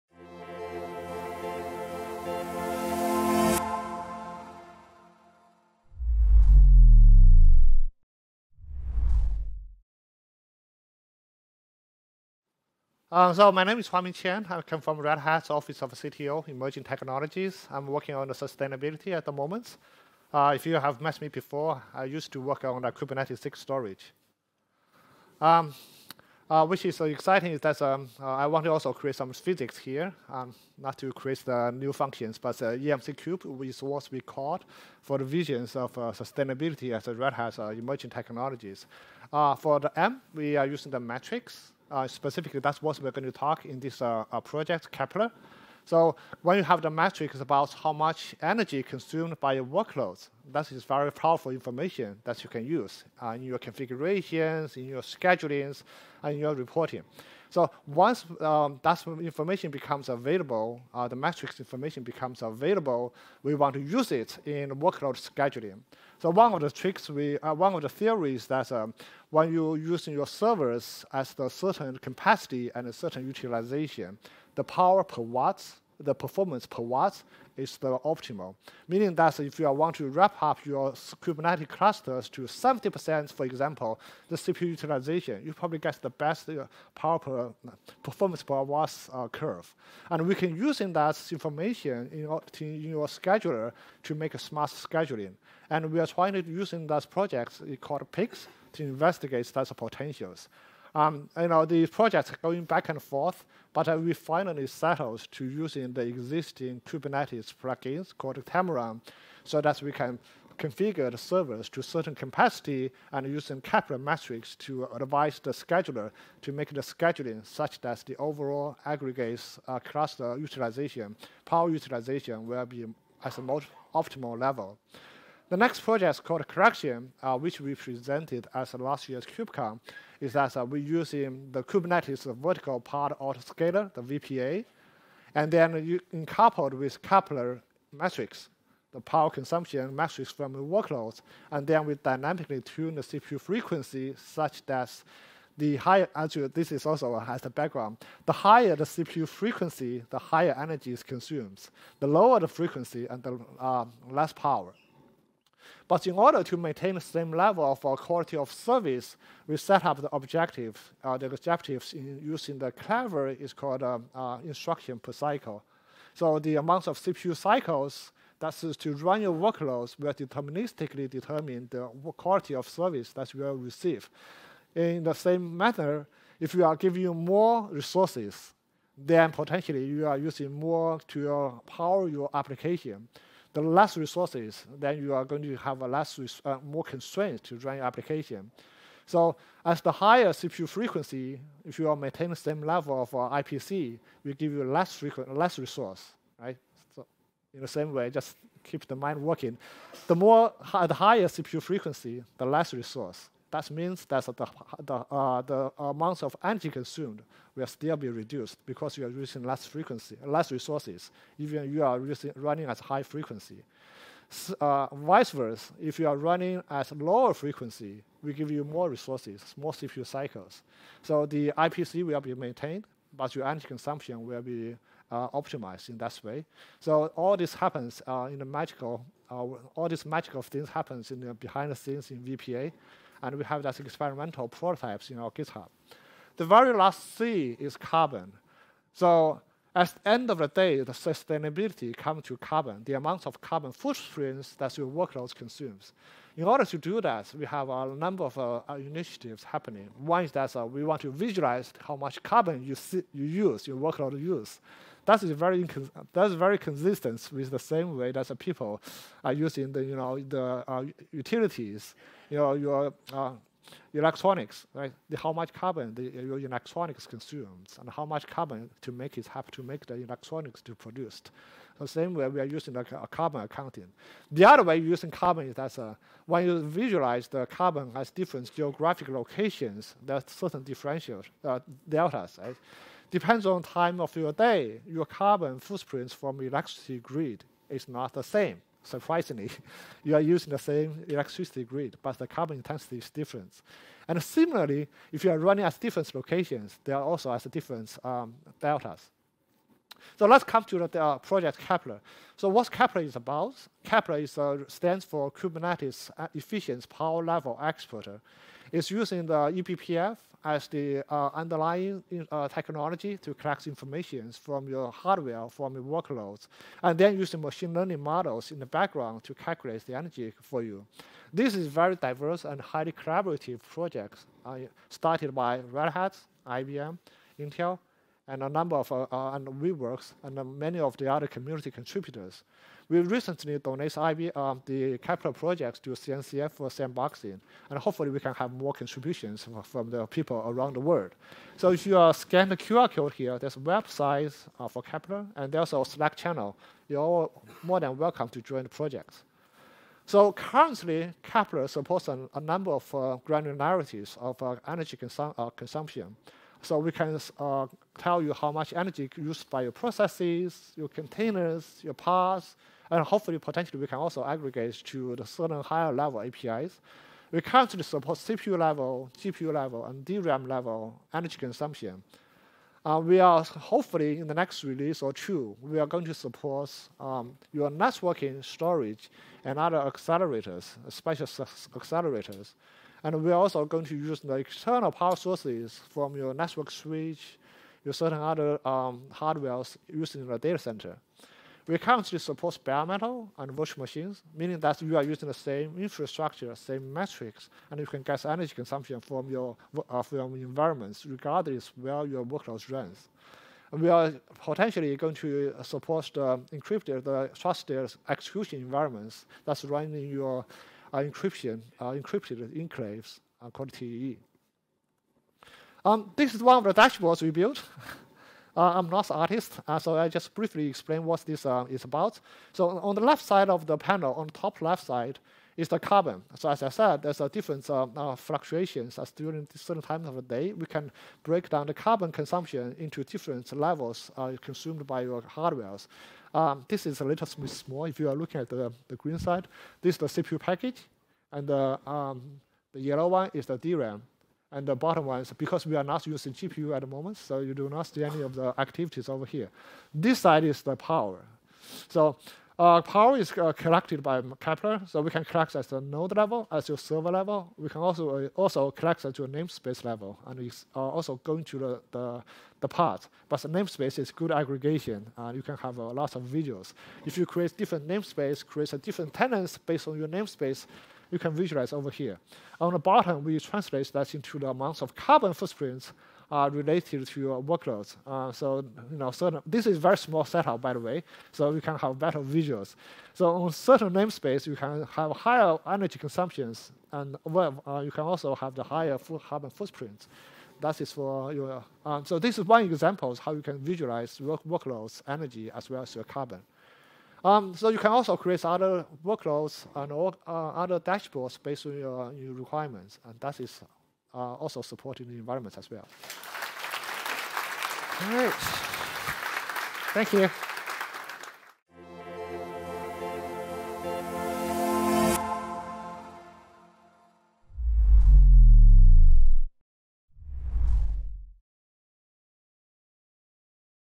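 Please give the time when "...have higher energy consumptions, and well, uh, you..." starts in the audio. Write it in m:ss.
8:04.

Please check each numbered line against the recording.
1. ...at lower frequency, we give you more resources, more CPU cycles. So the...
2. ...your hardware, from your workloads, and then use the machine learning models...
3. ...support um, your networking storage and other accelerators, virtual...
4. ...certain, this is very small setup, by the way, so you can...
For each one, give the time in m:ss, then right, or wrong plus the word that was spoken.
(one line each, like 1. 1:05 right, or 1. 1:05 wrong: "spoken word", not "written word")
1. 3:36 right
2. 5:14 right
3. 6:16 wrong: "special", not "virtual"
4. 7:59 right.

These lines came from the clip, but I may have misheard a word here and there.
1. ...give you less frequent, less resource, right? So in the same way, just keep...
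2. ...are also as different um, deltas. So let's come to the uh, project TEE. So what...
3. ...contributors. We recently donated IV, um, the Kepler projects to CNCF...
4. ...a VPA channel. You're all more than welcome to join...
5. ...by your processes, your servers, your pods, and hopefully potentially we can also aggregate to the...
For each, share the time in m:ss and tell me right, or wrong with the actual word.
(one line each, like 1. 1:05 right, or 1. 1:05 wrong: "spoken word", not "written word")
1. 3:14 right
2. 4:56 wrong: "Kepler", not "TEE"
3. 5:31 right
4. 5:45 wrong: "Slack", not "VPA"
5. 5:59 wrong: "containers", not "servers".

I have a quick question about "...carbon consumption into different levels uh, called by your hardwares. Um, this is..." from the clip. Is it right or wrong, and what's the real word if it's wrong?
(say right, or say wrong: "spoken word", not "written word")
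wrong: "consumed", not "called".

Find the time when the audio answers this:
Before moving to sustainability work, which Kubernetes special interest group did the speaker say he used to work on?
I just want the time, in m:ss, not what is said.
0:22.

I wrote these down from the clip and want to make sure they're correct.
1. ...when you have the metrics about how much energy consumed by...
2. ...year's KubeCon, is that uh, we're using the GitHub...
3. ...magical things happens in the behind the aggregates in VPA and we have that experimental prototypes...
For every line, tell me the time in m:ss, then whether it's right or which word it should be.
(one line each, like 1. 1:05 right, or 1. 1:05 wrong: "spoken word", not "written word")
1. 0:46 right
2. 2:09 wrong: "Kubernetes", not "GitHub"
3. 3:50 wrong: "scenes", not "aggregates".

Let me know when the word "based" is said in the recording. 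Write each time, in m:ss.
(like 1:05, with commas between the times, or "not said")
7:49, 8:21.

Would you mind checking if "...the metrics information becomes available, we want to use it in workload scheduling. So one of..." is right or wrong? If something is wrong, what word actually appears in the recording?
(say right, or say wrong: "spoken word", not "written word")
right.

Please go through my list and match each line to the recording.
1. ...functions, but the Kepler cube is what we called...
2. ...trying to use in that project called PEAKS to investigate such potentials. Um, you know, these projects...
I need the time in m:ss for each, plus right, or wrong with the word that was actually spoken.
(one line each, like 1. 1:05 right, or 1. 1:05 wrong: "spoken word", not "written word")
1. 0:31 wrong: "EMC", not "Kepler"
2. 1:36 right.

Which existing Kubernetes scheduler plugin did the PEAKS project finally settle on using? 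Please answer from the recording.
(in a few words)
Trimaran.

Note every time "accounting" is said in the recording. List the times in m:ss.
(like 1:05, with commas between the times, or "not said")
4:33.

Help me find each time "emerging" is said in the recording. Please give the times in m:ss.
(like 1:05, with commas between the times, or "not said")
0:16, 0:37.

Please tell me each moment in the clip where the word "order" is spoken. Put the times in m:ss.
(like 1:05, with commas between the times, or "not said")
2:36, 4:06.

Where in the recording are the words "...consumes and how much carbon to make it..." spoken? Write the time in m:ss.
4:27.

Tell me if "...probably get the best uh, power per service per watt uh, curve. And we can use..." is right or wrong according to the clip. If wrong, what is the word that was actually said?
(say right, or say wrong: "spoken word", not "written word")
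wrong: "performance", not "service".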